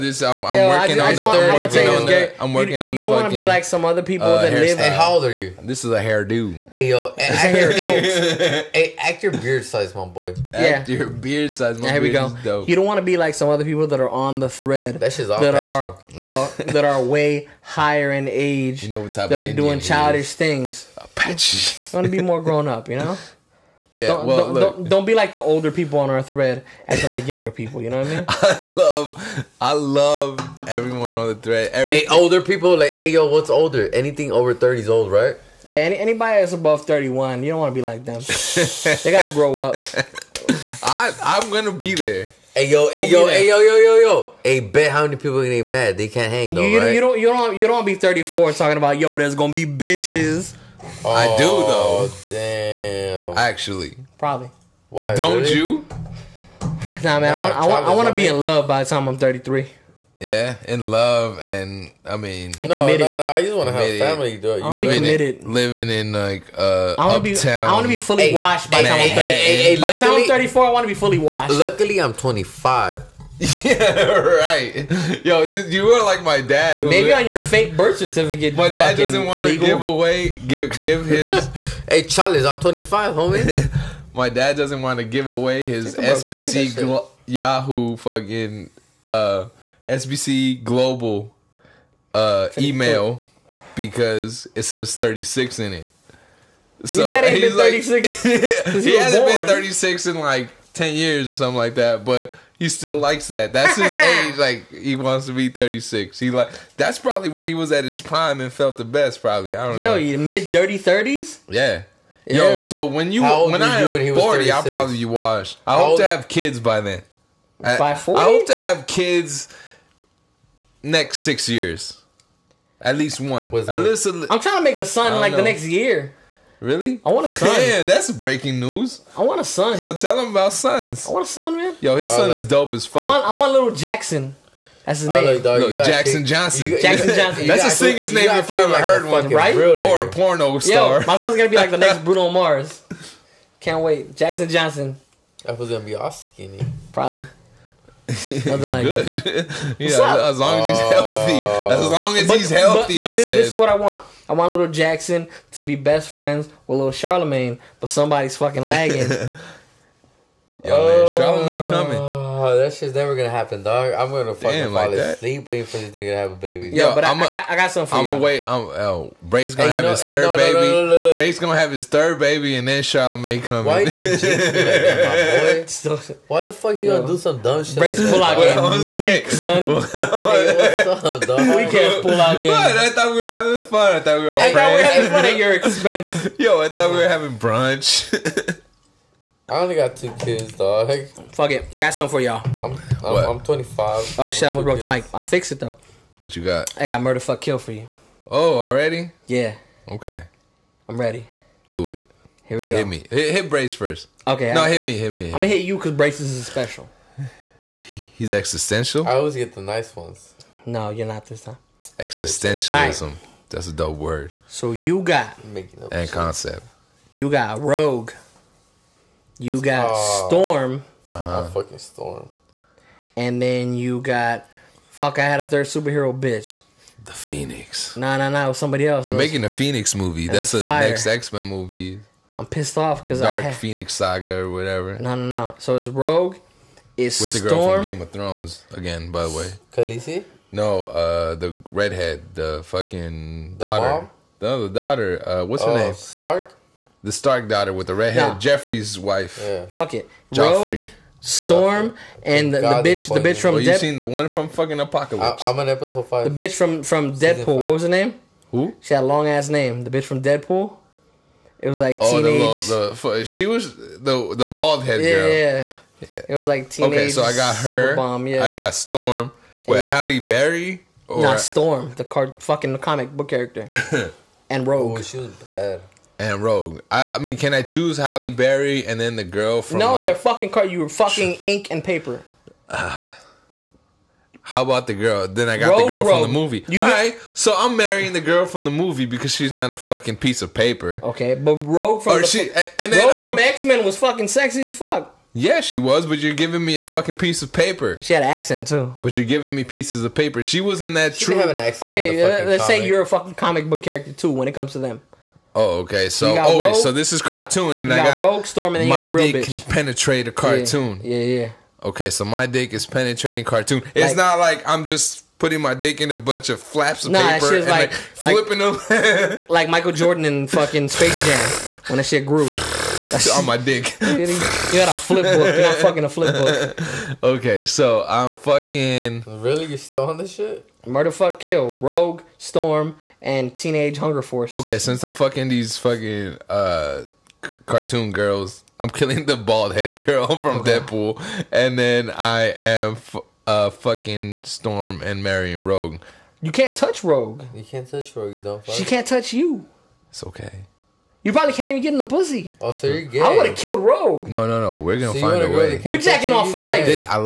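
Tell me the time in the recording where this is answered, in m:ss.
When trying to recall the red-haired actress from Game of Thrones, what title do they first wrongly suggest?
3:59.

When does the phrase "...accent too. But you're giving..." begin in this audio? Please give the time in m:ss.
4:58.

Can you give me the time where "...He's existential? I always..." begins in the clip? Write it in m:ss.
3:28.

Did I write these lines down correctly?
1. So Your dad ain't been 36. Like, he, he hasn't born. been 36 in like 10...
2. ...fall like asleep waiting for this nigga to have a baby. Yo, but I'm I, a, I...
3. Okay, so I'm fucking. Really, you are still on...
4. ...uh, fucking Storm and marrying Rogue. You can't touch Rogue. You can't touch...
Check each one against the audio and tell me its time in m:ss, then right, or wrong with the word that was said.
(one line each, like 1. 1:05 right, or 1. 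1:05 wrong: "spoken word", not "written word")
1. 1:36 right
2. 2:44 right
3. 5:27 right
4. 5:43 right.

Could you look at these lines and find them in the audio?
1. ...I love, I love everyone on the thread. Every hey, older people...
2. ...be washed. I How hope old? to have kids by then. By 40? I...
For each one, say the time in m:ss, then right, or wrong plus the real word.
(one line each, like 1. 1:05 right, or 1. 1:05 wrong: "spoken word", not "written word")
1. 0:28 right
2. 1:54 right.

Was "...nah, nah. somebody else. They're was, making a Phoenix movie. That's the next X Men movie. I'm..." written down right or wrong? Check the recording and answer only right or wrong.
right.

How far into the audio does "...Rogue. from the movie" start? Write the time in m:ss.
4:46.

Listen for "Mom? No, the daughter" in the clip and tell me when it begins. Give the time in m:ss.
4:04.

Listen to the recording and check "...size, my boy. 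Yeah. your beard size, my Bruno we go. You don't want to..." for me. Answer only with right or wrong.
wrong.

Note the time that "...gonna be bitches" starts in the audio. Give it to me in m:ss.
0:49.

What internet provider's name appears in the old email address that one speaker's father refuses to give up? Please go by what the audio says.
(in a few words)
SBC Global.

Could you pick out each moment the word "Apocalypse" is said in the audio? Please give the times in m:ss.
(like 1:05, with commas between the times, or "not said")
4:14.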